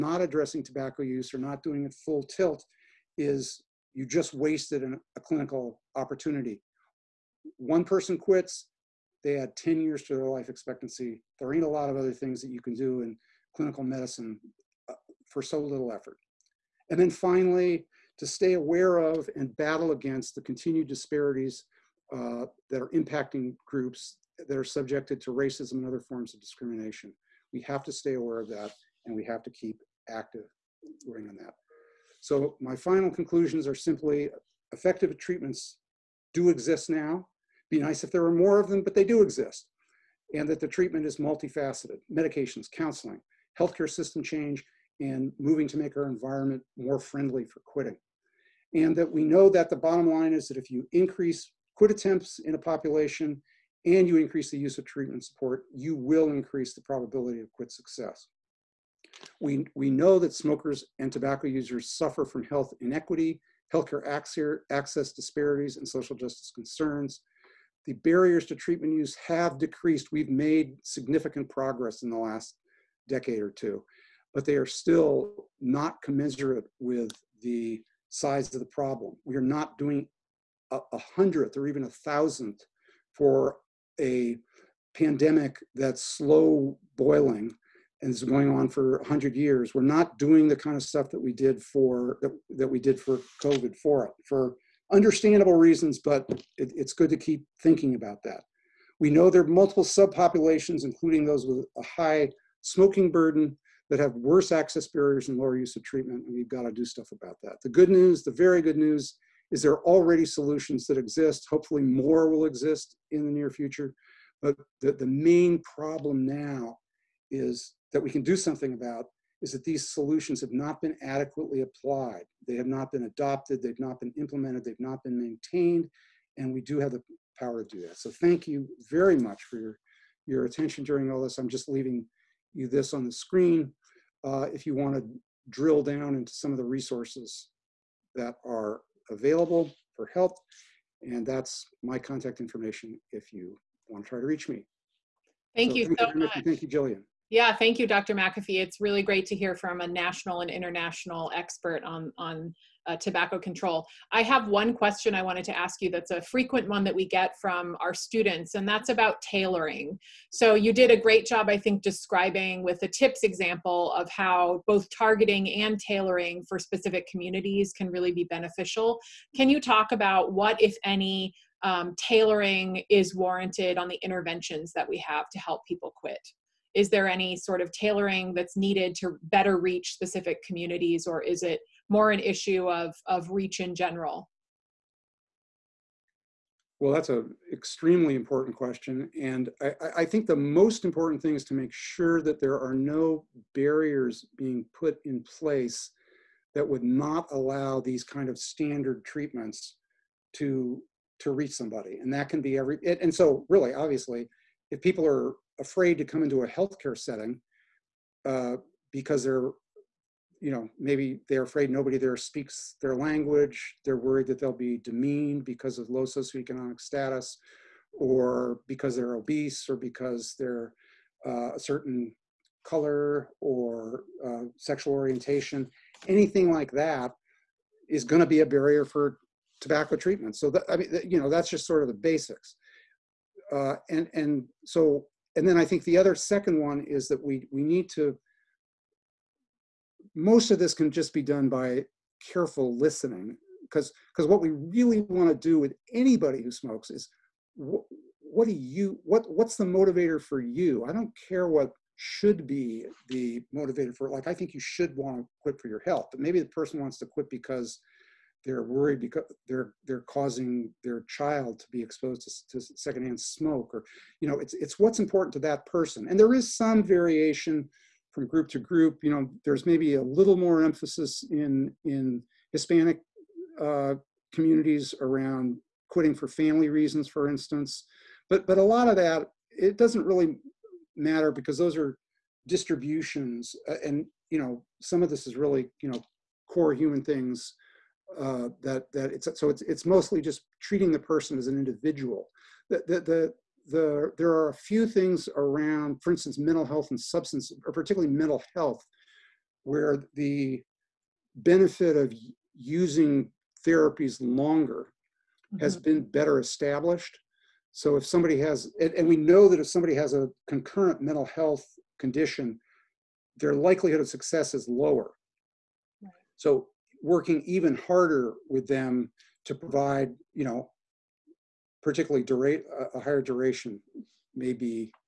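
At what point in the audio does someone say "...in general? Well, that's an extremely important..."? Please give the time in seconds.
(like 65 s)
183 s.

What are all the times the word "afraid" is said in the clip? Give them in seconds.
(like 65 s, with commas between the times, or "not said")
205 s, 211 s.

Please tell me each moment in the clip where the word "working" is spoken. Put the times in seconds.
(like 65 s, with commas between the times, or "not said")
31 s, 317 s.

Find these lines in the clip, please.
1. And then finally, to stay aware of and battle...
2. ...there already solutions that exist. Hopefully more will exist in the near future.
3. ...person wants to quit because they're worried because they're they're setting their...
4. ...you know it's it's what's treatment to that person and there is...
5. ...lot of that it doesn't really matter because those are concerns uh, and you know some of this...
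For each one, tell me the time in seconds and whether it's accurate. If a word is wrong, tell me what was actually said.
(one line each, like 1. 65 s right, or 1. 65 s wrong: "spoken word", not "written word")
1. 16 s right
2. 109 s right
3. 256 s wrong: "causing", not "setting"
4. 264 s wrong: "important", not "treatment"
5. 278 s wrong: "distributions", not "concerns".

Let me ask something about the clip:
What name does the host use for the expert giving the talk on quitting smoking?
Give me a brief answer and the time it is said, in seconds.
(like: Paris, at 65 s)
Dr. McAfee, at 147 s.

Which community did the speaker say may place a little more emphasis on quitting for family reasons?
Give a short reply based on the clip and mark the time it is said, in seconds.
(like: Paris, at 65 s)
Hispanic, at 272 s.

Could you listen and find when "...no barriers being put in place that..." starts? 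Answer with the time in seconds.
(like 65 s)
192 s.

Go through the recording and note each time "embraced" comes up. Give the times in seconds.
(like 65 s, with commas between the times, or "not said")
not said.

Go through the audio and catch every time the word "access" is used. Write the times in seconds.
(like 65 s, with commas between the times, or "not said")
64 s, 104 s.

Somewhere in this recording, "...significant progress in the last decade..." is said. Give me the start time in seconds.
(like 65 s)
70 s.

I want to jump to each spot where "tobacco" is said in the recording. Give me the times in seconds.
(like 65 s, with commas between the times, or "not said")
0 s, 61 s, 152 s, 229 s.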